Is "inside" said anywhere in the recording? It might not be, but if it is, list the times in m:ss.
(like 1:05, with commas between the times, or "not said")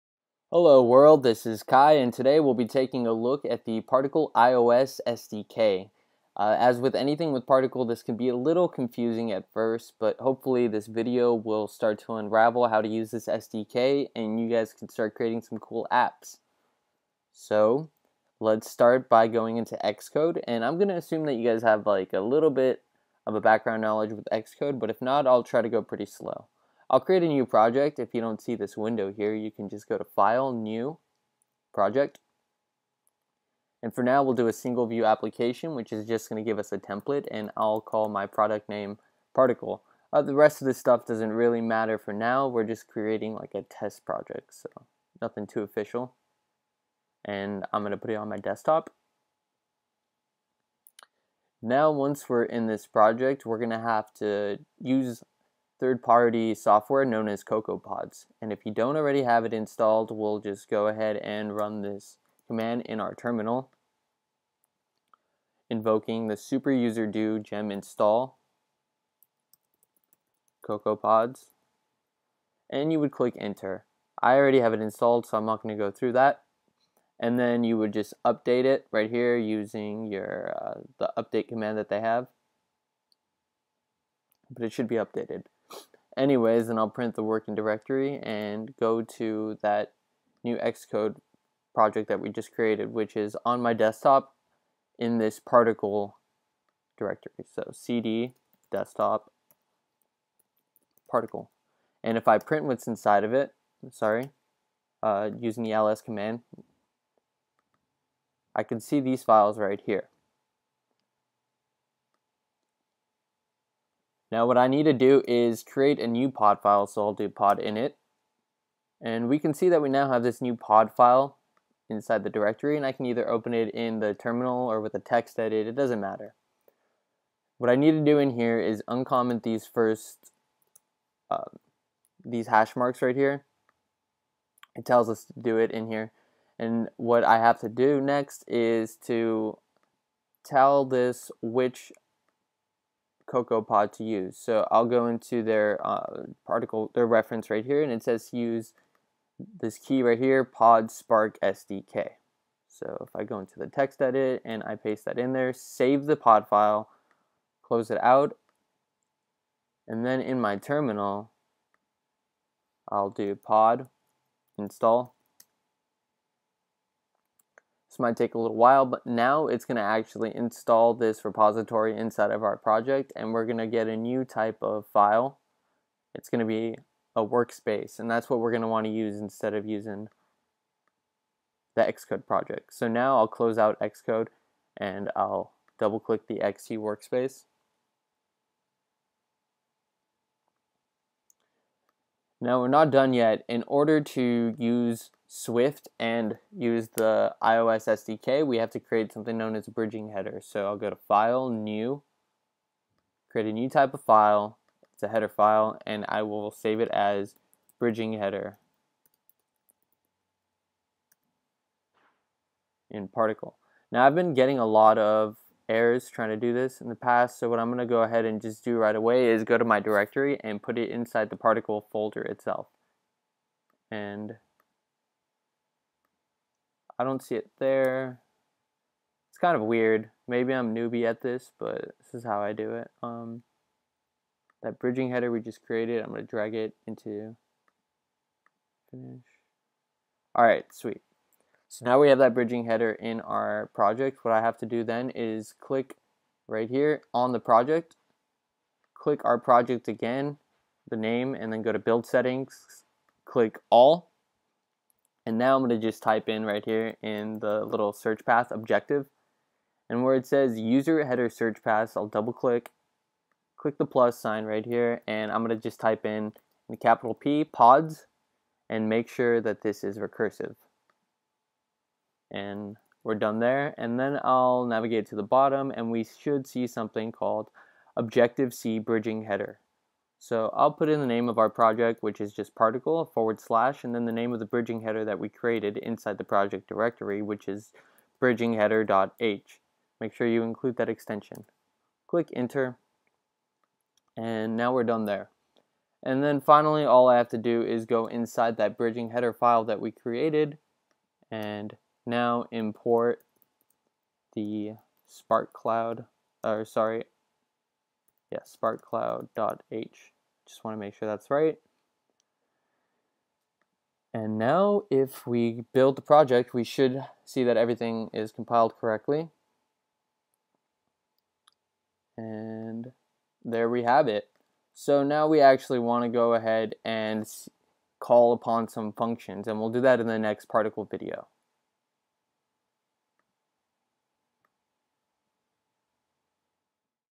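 1:42, 2:01, 2:51, 3:40, 4:45, 4:58.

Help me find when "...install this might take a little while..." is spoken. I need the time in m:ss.
2:44.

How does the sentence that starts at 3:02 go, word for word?
So now I'll close out Xcode, and I'll double-click the XC workspace.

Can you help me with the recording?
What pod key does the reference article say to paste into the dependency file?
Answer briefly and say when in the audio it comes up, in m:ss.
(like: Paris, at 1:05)
Spark SDK, at 2:30.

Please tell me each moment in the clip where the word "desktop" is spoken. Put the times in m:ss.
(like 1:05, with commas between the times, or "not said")
0:48, 1:33, 1:38.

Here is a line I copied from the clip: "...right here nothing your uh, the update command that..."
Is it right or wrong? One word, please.
wrong.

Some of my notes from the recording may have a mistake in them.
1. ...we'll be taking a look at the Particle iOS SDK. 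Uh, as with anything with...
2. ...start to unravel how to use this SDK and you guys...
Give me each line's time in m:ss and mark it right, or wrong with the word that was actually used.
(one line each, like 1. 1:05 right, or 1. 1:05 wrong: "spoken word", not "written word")
1. 0:02 right
2. 0:11 right.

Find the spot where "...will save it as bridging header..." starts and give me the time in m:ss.
3:26.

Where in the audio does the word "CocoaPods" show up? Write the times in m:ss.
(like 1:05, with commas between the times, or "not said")
0:57, 1:10, 2:23.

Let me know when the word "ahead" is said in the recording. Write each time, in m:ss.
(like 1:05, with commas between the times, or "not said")
1:00, 3:38, 5:26.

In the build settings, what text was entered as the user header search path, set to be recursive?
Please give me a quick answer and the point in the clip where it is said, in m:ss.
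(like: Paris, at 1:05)
Pods, at 4:26.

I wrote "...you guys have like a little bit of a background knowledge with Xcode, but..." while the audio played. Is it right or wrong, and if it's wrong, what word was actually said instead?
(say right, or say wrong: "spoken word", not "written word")
right.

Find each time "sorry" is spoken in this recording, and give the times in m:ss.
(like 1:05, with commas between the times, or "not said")
1:43, 5:06.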